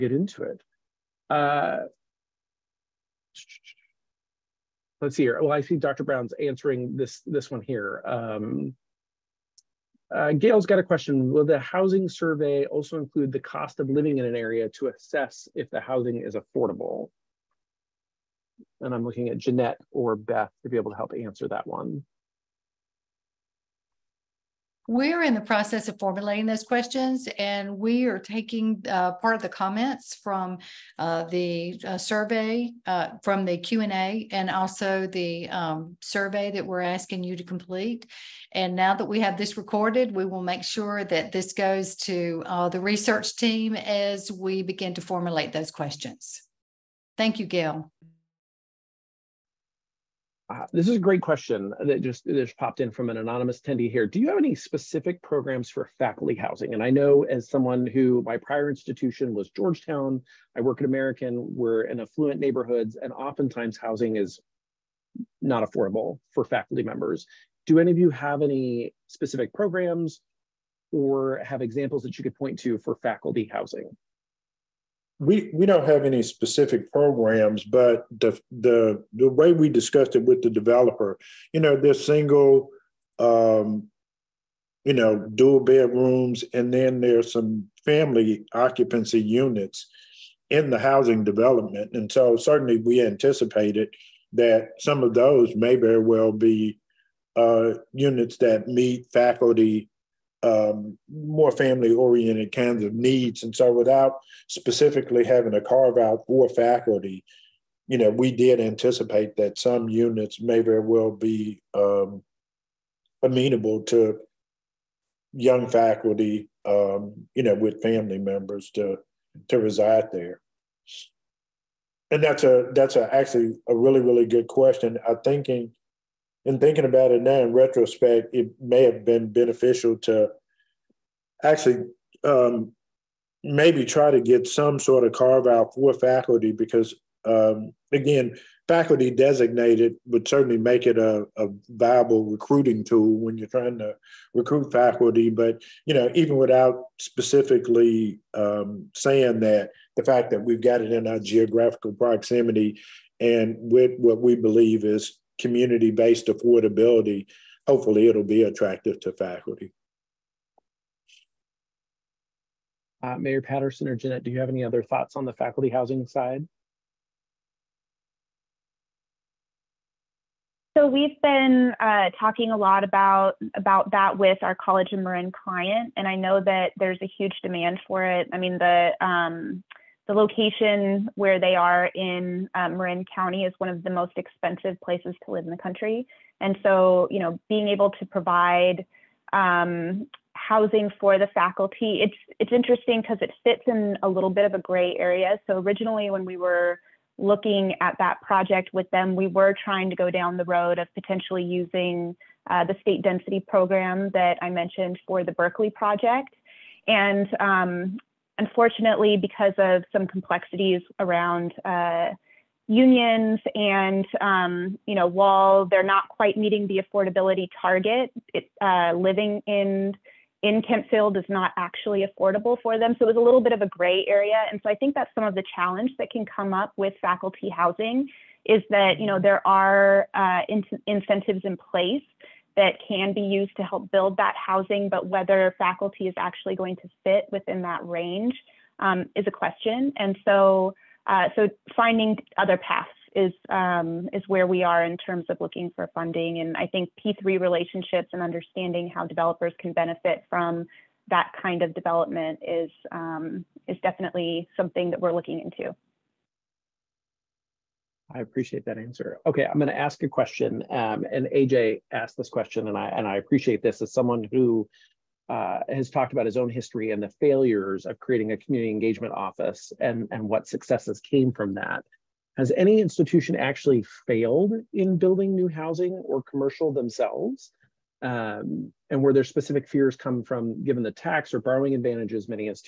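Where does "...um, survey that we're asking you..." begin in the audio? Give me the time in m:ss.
0:35.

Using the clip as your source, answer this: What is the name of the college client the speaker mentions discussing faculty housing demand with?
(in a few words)
College of Marin.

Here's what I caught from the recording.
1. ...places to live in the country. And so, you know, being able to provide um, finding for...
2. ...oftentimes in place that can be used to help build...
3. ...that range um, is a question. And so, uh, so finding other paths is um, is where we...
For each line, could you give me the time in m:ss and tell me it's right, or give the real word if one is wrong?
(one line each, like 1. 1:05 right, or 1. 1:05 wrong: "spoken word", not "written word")
1. 3:04 wrong: "housing", not "finding"
2. 3:50 wrong: "incentives", not "oftentimes"
3. 3:57 right.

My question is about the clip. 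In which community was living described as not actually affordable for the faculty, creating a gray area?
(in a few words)
Kentfield.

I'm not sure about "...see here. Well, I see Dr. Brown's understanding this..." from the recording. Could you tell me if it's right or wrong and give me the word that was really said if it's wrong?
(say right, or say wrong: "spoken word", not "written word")
wrong: "answering", not "understanding".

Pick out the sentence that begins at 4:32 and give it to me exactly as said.
Has any institution actually failed in building new housing or commercial themselves?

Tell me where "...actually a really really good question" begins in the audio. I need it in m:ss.
2:03.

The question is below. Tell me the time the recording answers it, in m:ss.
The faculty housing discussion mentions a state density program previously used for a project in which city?
3:25.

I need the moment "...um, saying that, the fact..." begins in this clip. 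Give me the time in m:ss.
2:28.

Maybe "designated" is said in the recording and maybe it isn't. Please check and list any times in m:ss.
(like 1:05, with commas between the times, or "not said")
2:19.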